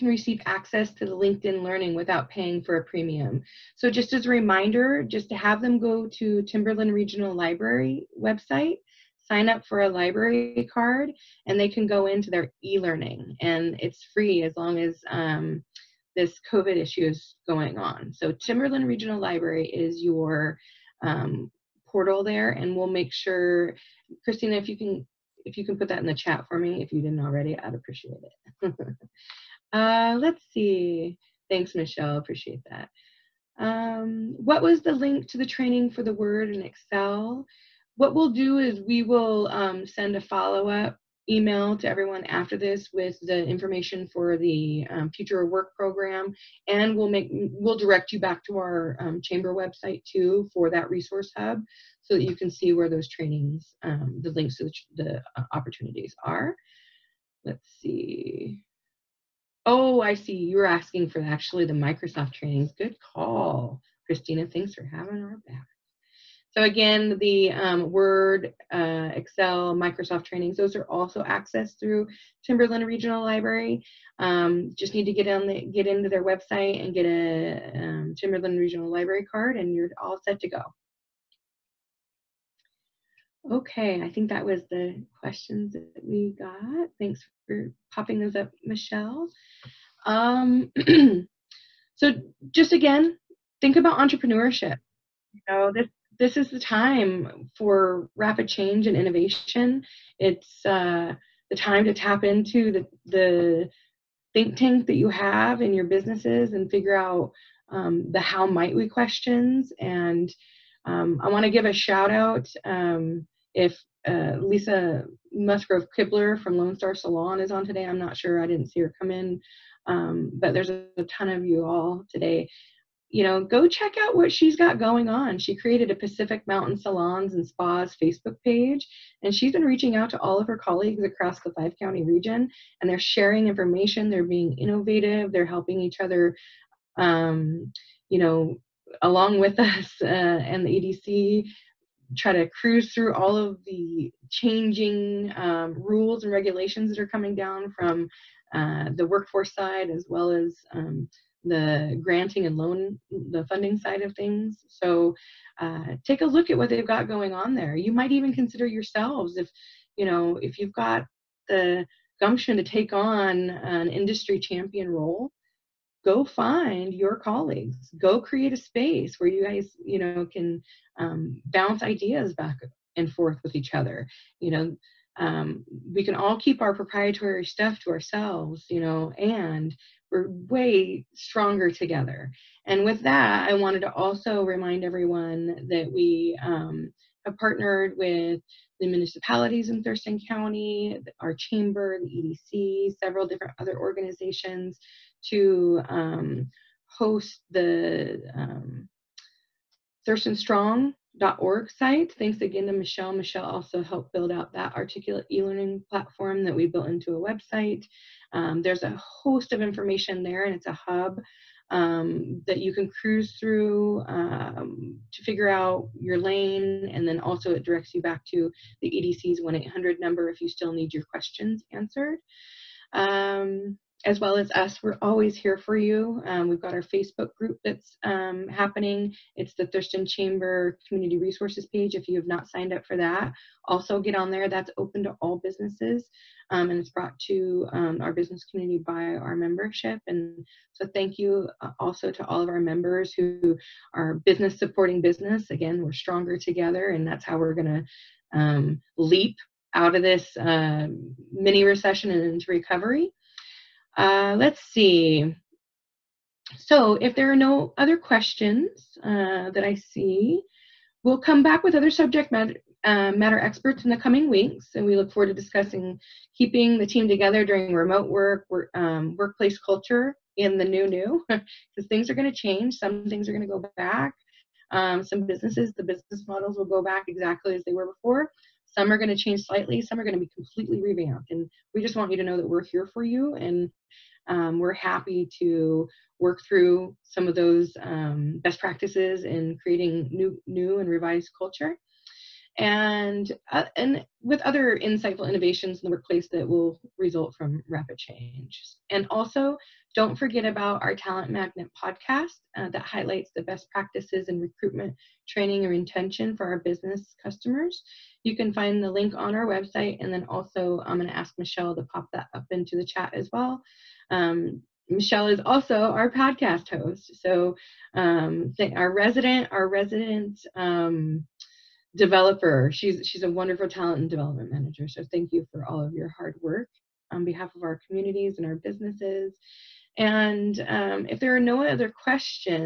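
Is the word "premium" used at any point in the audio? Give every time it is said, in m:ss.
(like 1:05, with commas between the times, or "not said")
0:02.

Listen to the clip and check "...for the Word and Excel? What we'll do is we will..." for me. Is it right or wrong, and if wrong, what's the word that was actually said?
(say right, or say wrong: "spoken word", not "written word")
right.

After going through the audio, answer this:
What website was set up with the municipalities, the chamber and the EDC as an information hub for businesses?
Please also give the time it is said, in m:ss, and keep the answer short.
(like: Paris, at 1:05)
thurstonstrong.org, at 3:20.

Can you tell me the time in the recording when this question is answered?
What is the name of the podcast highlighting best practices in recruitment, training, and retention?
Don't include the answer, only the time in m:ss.
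5:00.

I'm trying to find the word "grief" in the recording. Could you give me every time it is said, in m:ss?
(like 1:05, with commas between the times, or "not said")
not said.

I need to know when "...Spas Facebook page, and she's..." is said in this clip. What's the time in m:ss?
2:07.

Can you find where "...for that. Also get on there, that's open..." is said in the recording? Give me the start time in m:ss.
3:52.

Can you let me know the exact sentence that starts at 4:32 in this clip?
Some things are going to go back.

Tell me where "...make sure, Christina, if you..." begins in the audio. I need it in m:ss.
0:22.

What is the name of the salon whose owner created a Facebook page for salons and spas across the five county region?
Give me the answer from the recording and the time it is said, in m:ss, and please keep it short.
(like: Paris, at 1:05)
Lone Star Salon, at 1:56.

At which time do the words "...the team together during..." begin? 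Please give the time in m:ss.
4:26.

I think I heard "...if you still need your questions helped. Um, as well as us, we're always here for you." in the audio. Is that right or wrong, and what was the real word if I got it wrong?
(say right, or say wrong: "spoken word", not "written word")
wrong: "answered", not "helped".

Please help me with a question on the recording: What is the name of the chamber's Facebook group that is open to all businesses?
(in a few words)
Thurston Chamber Community Resources.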